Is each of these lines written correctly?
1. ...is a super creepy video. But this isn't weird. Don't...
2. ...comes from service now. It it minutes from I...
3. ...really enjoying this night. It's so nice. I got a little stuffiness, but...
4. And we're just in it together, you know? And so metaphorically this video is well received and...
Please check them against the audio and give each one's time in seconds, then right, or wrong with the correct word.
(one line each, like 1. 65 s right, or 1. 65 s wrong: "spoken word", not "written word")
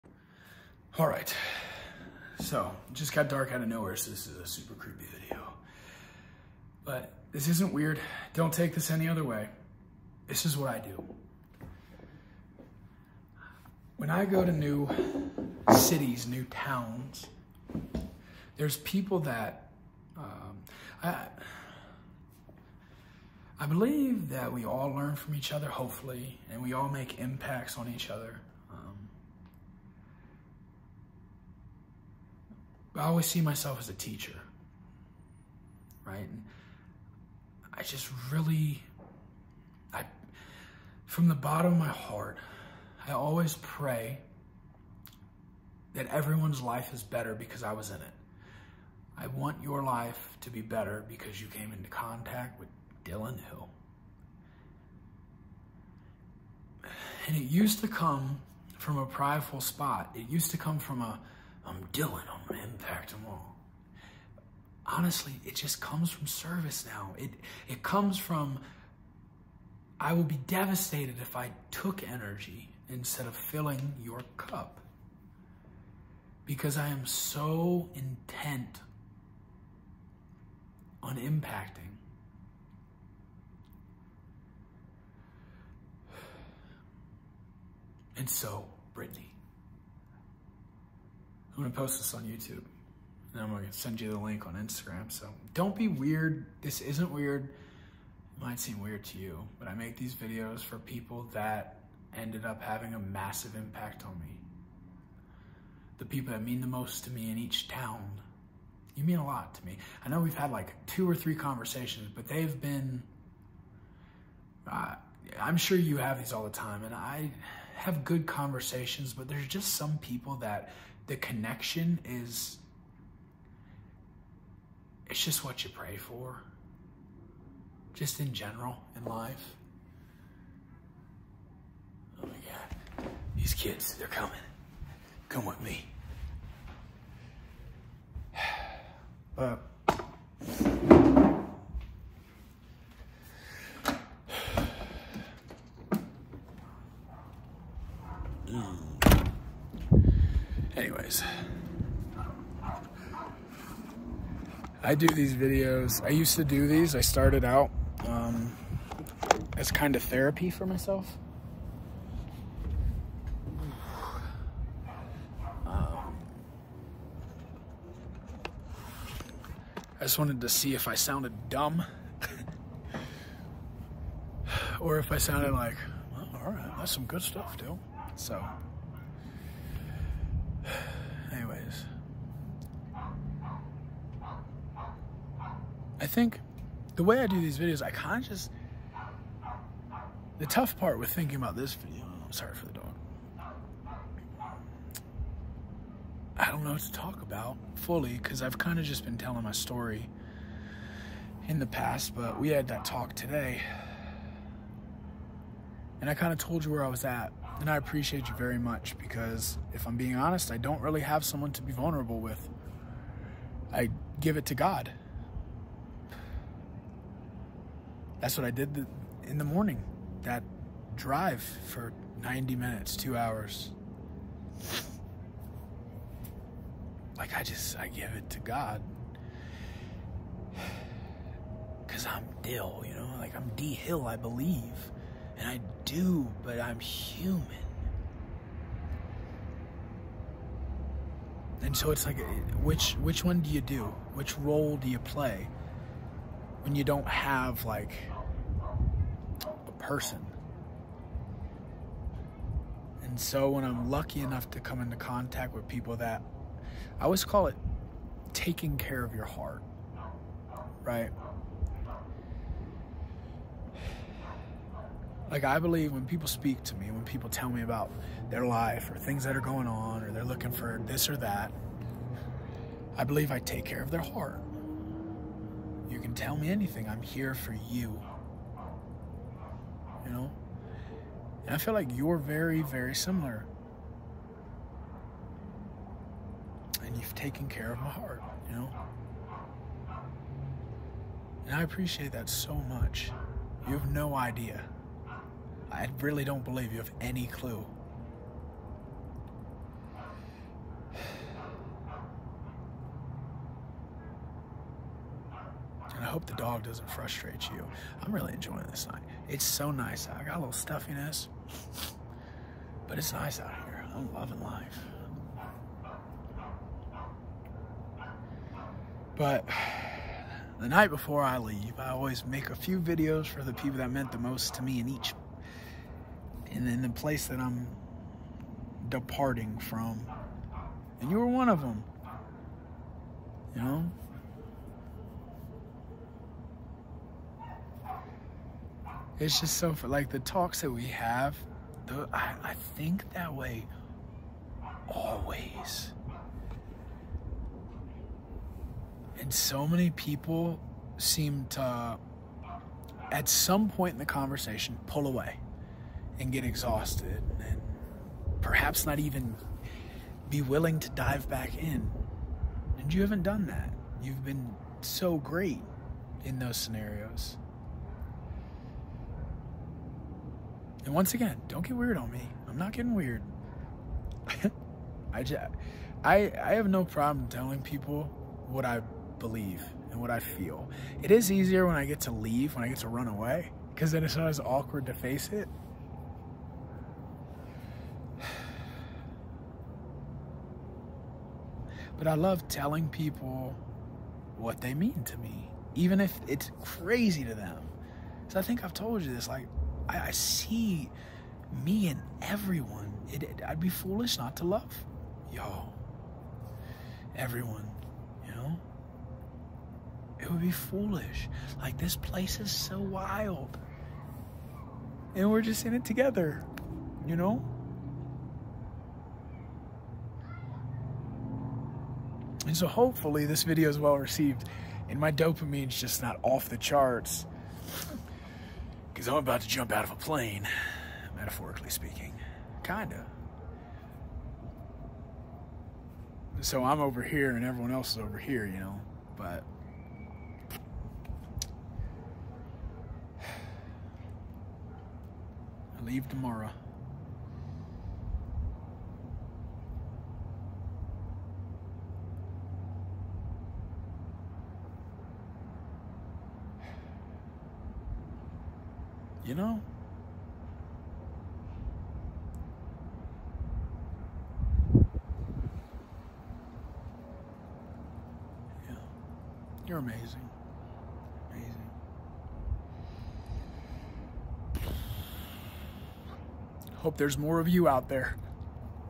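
1. 4 s right
2. 65 s wrong: "comes", not "minutes"
3. 308 s right
4. 415 s wrong: "hopefully", not "metaphorically".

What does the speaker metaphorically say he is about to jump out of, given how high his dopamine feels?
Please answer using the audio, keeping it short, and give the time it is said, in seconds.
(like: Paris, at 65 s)
a plane, at 429 s.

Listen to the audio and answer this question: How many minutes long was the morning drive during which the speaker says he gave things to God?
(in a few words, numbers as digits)
90.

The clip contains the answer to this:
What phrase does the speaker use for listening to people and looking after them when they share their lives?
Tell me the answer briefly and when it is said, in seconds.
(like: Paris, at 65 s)
taking care of your heart, at 258 s.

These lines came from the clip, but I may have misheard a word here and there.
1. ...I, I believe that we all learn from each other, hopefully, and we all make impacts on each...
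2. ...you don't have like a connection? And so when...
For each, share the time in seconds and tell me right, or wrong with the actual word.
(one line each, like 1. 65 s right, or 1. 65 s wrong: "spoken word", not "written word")
1. 21 s right
2. 246 s wrong: "person", not "connection".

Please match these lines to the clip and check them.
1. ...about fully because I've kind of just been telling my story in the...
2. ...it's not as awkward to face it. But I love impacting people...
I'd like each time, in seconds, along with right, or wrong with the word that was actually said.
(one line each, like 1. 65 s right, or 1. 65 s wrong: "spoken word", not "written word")
1. 197 s right
2. 384 s wrong: "telling", not "impacting".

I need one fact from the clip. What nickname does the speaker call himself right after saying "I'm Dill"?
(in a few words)
D Hill.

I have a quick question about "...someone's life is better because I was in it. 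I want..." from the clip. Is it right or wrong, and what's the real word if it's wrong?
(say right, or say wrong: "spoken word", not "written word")
wrong: "everyone", not "someone".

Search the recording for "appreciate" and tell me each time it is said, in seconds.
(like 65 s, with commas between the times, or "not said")
207 s, 291 s.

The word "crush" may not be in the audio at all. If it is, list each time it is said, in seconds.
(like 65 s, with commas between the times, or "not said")
not said.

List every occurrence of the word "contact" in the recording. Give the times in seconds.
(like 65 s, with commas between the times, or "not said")
51 s, 254 s.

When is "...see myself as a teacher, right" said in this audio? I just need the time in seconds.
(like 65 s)
33 s.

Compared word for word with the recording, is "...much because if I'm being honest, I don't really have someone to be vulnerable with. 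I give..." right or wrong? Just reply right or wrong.
right.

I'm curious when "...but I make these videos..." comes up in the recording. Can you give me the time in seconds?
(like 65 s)
99 s.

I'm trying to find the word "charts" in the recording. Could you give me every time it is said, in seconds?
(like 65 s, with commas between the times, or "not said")
426 s.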